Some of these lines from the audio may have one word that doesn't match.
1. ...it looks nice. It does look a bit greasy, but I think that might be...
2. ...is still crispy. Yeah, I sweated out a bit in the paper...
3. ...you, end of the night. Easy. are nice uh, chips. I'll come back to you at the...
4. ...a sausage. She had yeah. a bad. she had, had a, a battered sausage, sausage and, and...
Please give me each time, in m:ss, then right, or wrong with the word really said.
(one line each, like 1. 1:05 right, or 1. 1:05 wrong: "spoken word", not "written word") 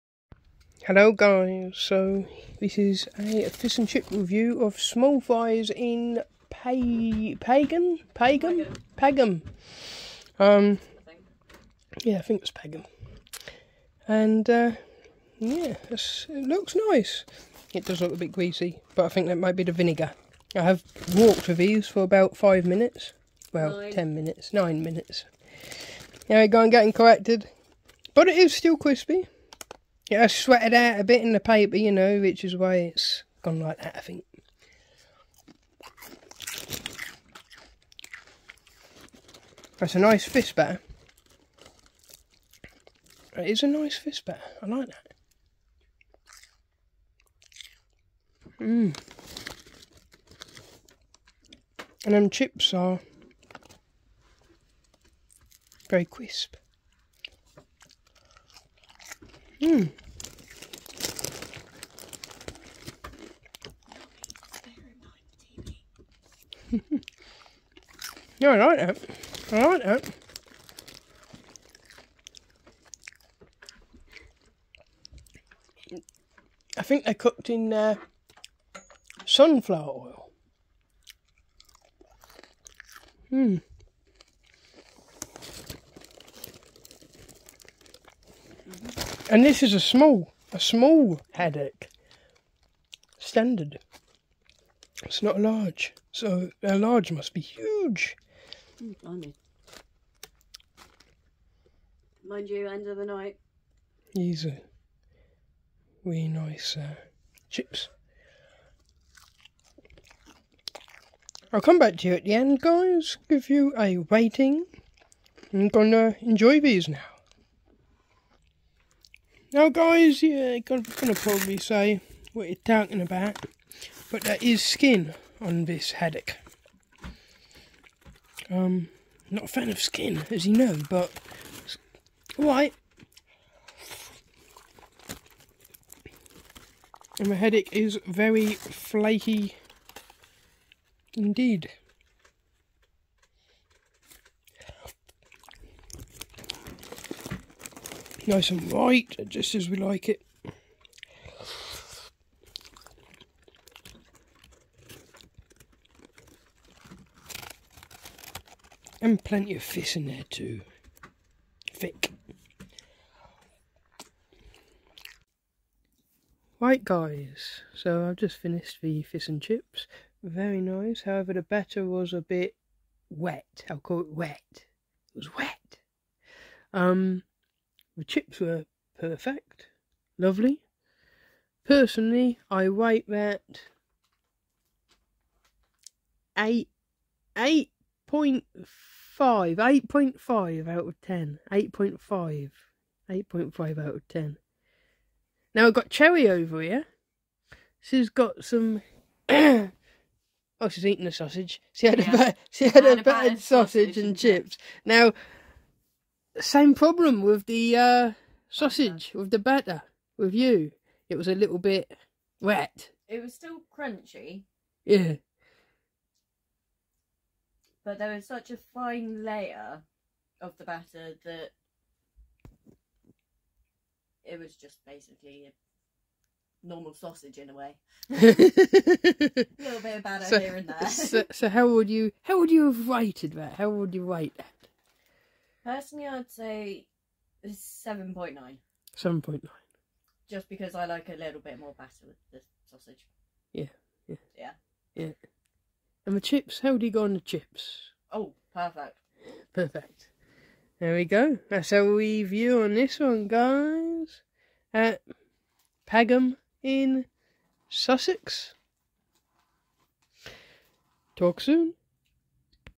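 1. 0:15 right
2. 0:28 right
3. 1:42 right
4. 3:21 right.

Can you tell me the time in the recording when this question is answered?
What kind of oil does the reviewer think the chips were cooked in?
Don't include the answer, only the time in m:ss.
1:19.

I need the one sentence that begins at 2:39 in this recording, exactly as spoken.
And plenty of fish in there too.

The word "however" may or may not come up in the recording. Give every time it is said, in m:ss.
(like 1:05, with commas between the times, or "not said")
2:51.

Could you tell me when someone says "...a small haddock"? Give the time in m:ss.
1:30.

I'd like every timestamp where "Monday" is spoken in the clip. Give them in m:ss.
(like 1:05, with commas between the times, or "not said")
not said.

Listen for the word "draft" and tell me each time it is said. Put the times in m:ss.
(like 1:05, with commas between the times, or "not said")
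not said.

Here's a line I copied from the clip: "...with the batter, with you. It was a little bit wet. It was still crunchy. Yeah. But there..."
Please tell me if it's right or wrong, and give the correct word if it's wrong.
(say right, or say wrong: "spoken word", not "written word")
right.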